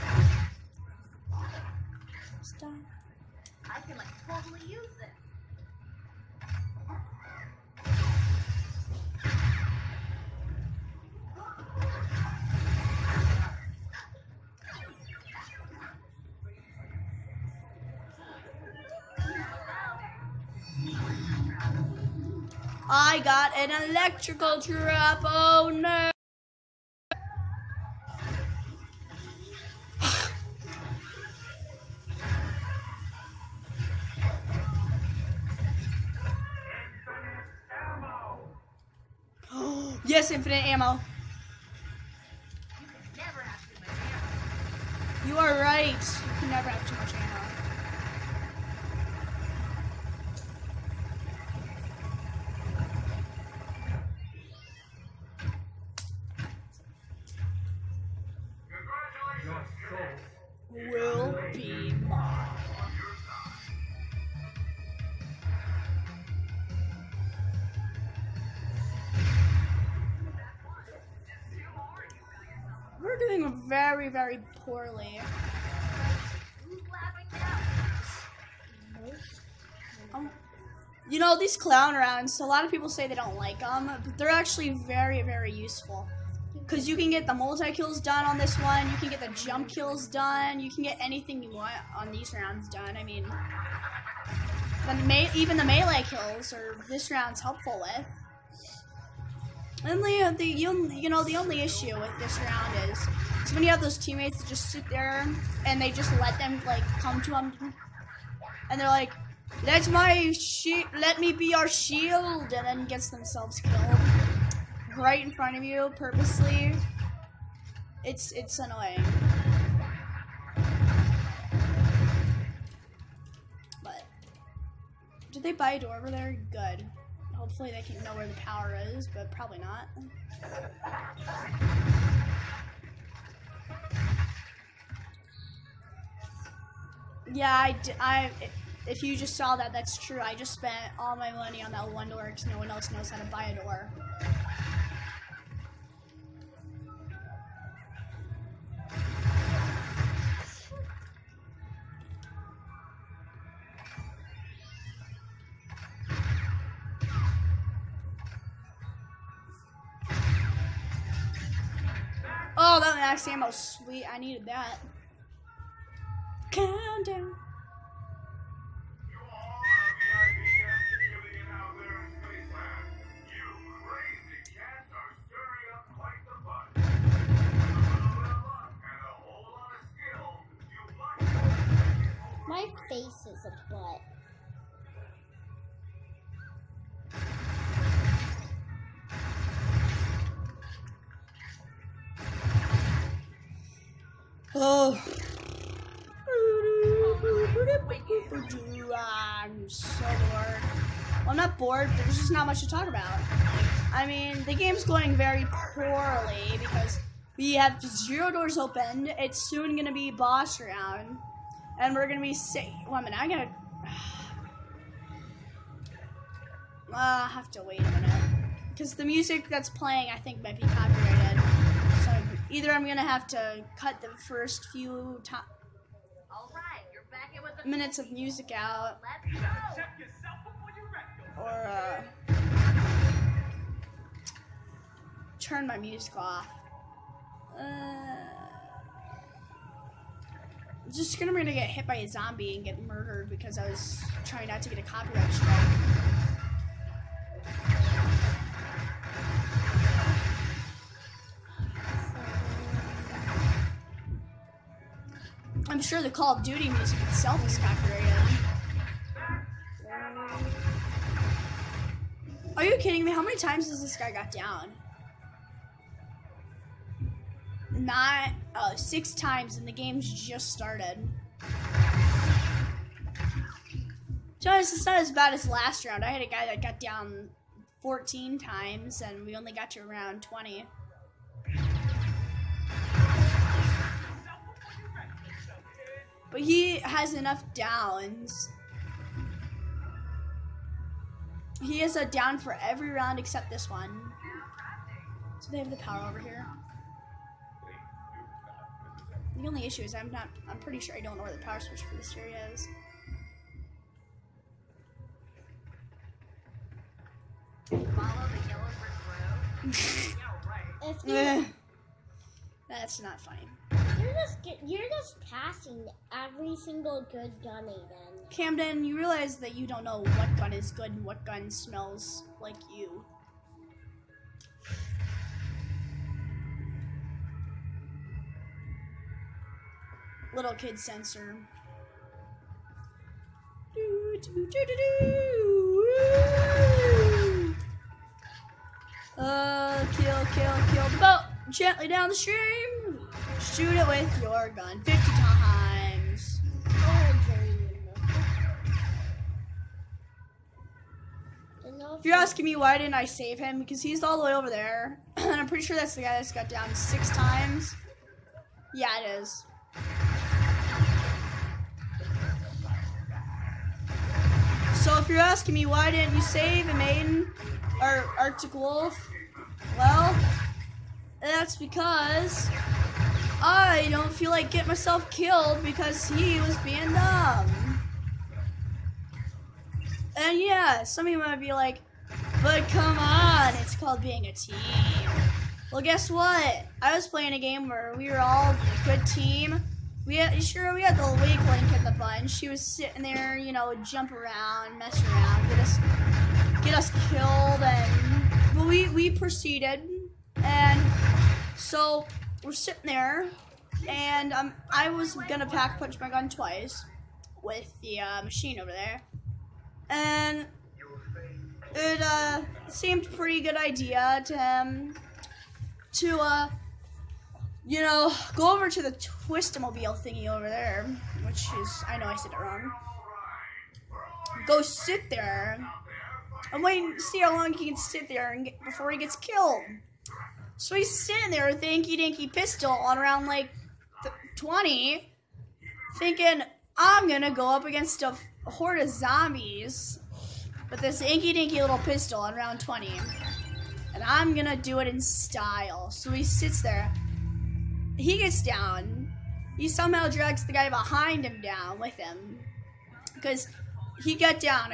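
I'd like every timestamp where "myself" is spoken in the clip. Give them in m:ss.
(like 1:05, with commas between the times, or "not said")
6:14.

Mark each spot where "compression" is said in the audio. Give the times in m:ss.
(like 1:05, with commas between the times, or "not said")
not said.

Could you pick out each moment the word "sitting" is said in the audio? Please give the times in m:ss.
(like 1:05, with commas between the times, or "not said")
6:32, 6:42, 7:11.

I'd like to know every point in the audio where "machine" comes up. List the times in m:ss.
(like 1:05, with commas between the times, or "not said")
6:48.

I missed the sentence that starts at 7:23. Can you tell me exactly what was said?
And I'm gonna do it in style.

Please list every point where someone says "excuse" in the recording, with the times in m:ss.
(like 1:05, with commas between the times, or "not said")
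not said.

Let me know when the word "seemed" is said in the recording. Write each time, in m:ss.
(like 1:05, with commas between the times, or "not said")
6:52.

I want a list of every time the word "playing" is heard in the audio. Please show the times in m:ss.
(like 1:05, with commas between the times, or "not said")
3:39, 6:27.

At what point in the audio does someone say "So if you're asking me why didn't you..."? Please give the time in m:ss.
6:04.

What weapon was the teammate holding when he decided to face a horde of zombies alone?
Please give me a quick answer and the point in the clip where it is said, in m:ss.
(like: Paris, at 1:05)
Inky Dinky pistol, at 7:11.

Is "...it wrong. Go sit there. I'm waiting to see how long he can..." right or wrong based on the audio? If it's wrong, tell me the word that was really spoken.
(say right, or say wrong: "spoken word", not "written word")
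right.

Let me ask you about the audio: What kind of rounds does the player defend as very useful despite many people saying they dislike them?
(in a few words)
clown rounds.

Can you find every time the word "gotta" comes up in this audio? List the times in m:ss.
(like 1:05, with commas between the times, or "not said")
3:33.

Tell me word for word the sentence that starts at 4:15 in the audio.
I'm sure the Call of Duty music itself is copyrighted.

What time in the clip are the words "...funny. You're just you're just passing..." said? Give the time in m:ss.
5:13.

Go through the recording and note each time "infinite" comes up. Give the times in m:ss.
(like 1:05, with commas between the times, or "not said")
0:40.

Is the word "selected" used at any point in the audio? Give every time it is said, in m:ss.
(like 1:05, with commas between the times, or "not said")
not said.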